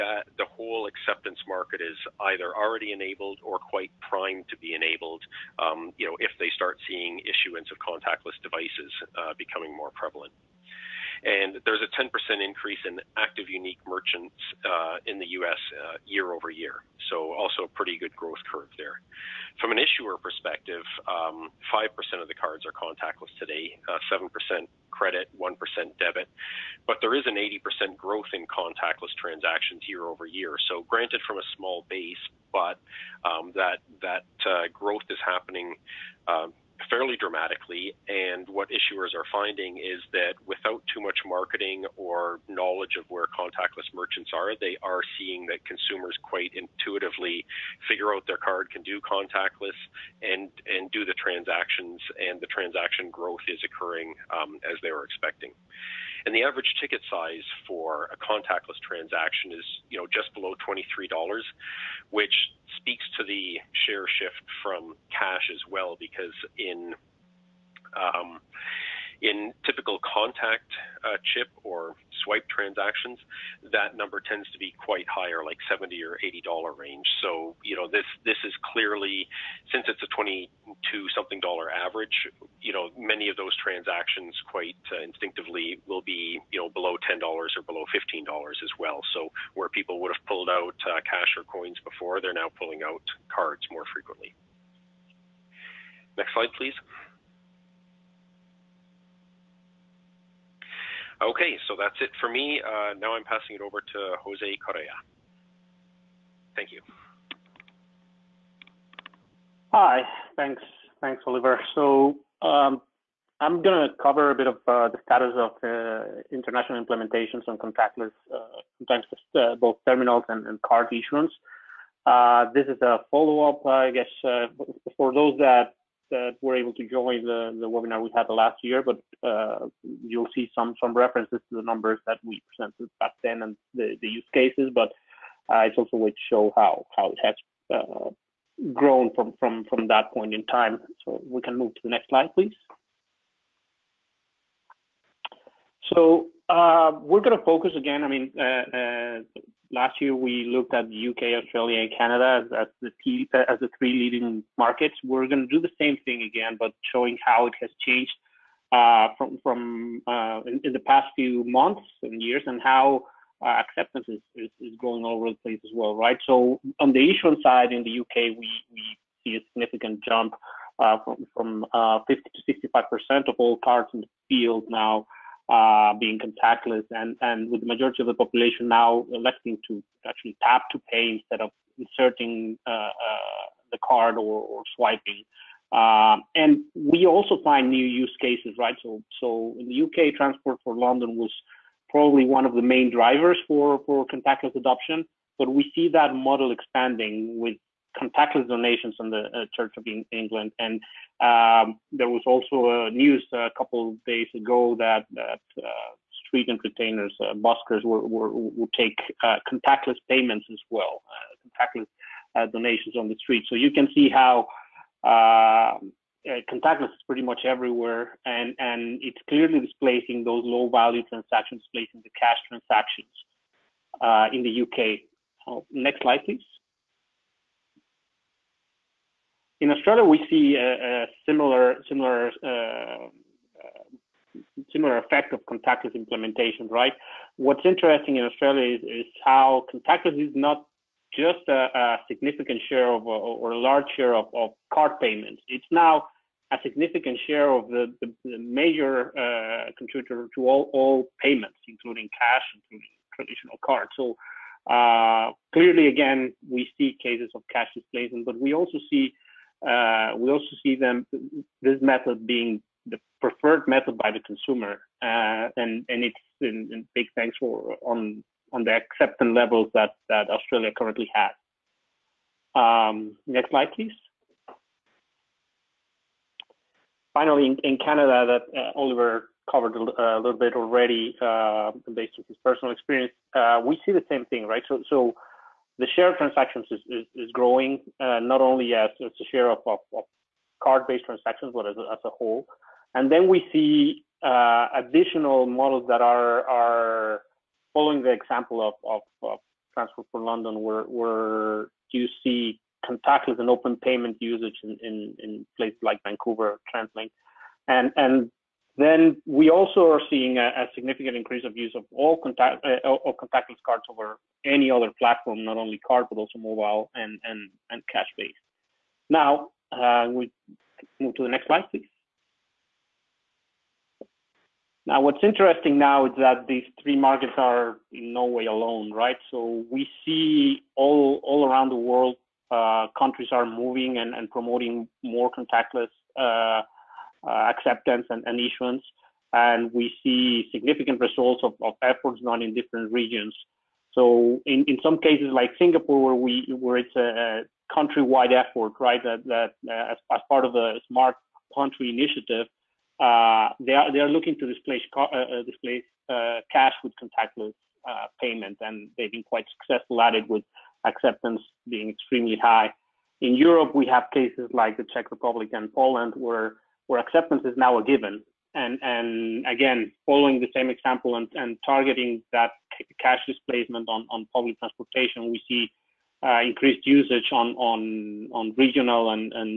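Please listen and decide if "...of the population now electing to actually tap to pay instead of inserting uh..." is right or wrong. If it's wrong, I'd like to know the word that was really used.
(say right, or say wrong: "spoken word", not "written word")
right.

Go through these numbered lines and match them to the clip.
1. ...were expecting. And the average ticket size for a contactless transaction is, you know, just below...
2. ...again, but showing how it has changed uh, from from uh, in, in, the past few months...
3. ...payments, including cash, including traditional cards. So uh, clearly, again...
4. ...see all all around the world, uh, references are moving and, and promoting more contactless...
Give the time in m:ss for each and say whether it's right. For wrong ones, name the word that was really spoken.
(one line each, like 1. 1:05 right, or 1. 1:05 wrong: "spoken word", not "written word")
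1. 0:54 right
2. 2:36 right
3. 4:11 right
4. 5:30 wrong: "countries", not "references".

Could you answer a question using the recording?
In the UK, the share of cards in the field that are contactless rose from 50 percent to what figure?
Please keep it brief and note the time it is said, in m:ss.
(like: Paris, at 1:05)
65%, at 2:52.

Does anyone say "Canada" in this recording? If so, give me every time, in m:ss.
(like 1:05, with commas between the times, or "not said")
2:31, 4:37.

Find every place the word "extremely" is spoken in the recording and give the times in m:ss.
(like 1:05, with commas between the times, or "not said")
6:01.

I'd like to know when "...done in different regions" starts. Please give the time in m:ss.
5:42.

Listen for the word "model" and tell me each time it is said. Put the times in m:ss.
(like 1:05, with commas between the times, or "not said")
3:16, 4:55.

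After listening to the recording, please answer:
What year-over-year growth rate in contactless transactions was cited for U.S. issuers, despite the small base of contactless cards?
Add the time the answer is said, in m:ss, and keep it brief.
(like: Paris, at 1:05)
80%, at 0:27.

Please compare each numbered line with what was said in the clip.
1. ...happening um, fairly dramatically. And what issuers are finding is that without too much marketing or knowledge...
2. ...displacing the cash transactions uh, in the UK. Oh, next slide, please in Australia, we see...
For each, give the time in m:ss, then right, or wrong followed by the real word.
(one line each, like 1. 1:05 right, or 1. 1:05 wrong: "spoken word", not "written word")
1. 0:35 right
2. 3:41 right.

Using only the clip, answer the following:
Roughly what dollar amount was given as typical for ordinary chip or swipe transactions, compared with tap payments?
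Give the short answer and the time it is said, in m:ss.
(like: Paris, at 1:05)
70 or 80 dollars, at 1:15.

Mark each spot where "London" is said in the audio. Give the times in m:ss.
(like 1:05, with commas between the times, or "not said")
3:10, 5:00.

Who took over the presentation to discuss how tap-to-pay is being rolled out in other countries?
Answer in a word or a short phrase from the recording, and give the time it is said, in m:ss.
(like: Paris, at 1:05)
Jose Correa, at 1:44.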